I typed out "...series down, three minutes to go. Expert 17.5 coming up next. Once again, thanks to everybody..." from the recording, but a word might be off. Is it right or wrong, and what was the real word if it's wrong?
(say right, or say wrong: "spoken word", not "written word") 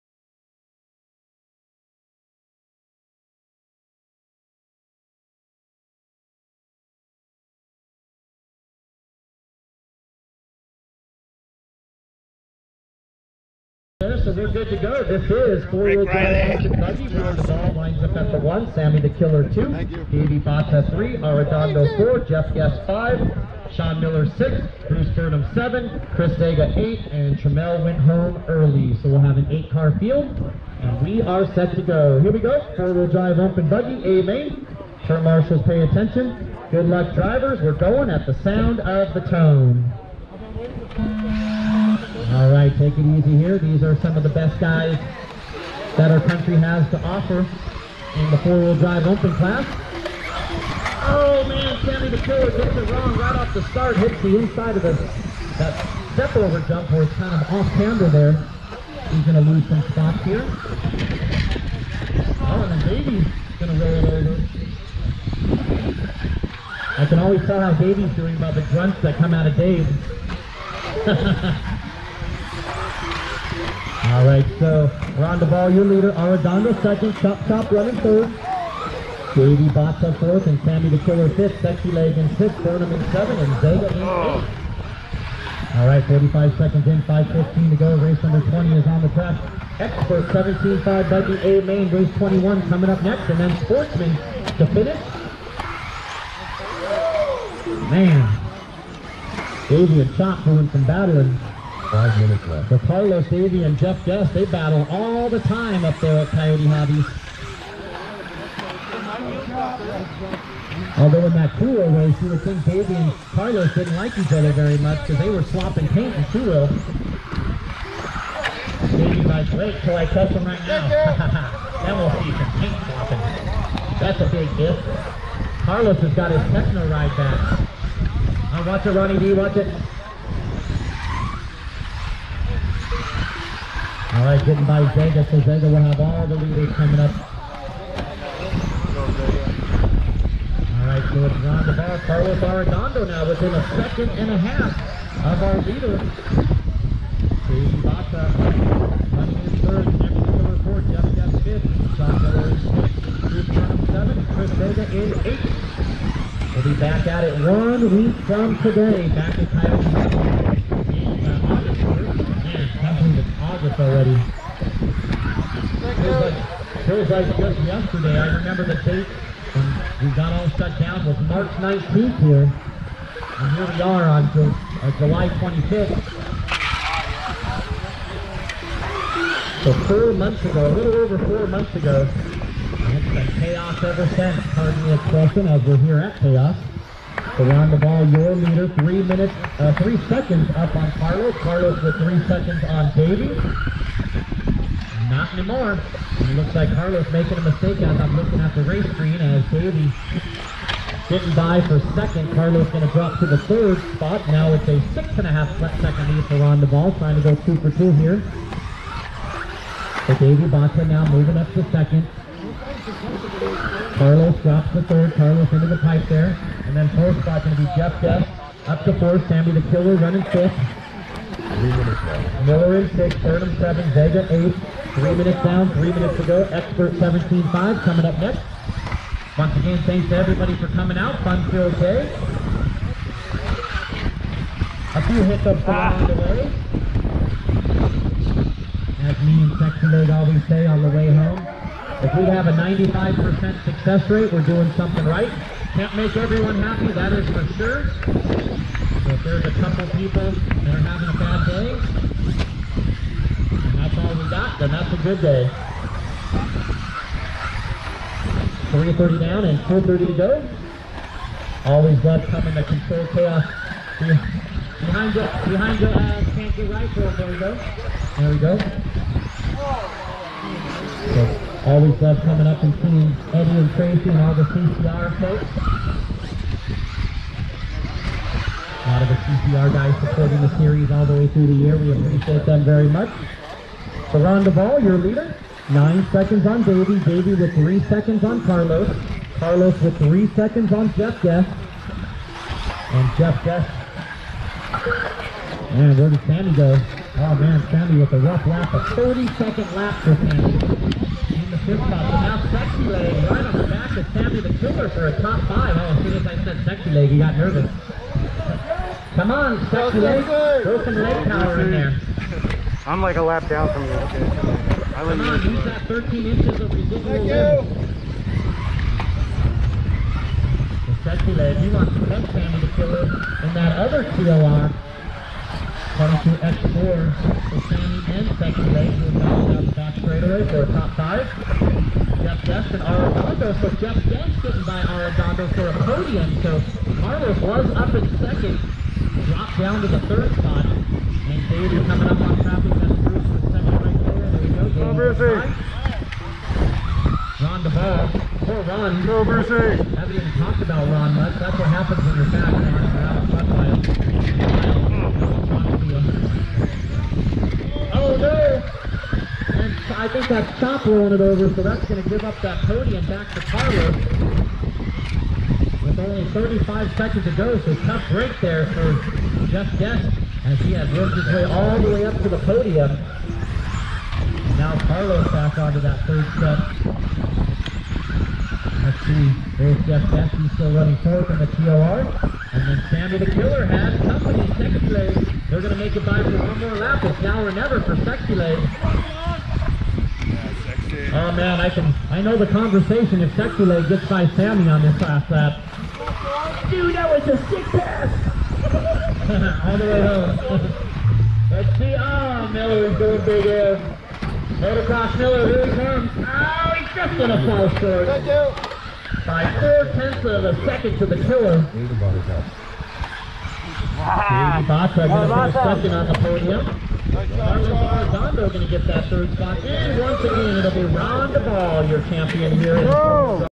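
wrong: "minutes", not "series".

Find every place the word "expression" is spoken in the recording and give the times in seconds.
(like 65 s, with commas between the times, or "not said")
184 s.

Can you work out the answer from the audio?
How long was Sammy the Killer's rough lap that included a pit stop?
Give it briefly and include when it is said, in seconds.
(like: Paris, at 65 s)
30 seconds, at 298 s.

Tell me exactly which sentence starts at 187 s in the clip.
Around the ball, your leader, three minutes, uh, three seconds up on Carlos.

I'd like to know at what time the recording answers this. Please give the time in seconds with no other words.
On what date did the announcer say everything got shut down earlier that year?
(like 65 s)
171 s.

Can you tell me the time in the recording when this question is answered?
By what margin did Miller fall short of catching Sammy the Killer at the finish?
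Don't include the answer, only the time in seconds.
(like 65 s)
409 s.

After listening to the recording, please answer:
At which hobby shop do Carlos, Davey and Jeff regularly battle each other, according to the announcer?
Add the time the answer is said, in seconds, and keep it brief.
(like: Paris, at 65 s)
Coyote Hobbies, at 106 s.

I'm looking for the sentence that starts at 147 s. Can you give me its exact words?
Jason Baca running his third, Jefferson to report, Jeff Jeff fifth, Sean Miller is sixth, Bruce Seven, Chris Vega in eighth.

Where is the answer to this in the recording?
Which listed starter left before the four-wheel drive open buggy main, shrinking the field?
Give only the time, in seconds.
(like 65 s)
27 s.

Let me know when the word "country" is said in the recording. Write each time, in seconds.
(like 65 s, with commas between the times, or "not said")
46 s.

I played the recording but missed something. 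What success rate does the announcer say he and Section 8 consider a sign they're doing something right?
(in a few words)
95%.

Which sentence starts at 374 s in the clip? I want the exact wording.
now Carlos back onto that third step number see there's Jeff Beck, he's still running fourth in the TLR.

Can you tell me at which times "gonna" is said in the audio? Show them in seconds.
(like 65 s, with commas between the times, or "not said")
59 s, 63 s, 407 s.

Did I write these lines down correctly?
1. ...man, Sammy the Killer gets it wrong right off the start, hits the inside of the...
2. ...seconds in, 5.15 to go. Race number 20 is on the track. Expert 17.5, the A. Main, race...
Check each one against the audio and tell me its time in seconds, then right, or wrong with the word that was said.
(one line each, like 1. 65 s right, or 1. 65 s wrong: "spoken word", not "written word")
1. 51 s right
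2. 86 s right.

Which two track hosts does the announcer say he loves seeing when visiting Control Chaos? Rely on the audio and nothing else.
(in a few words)
Eddie and Tracy.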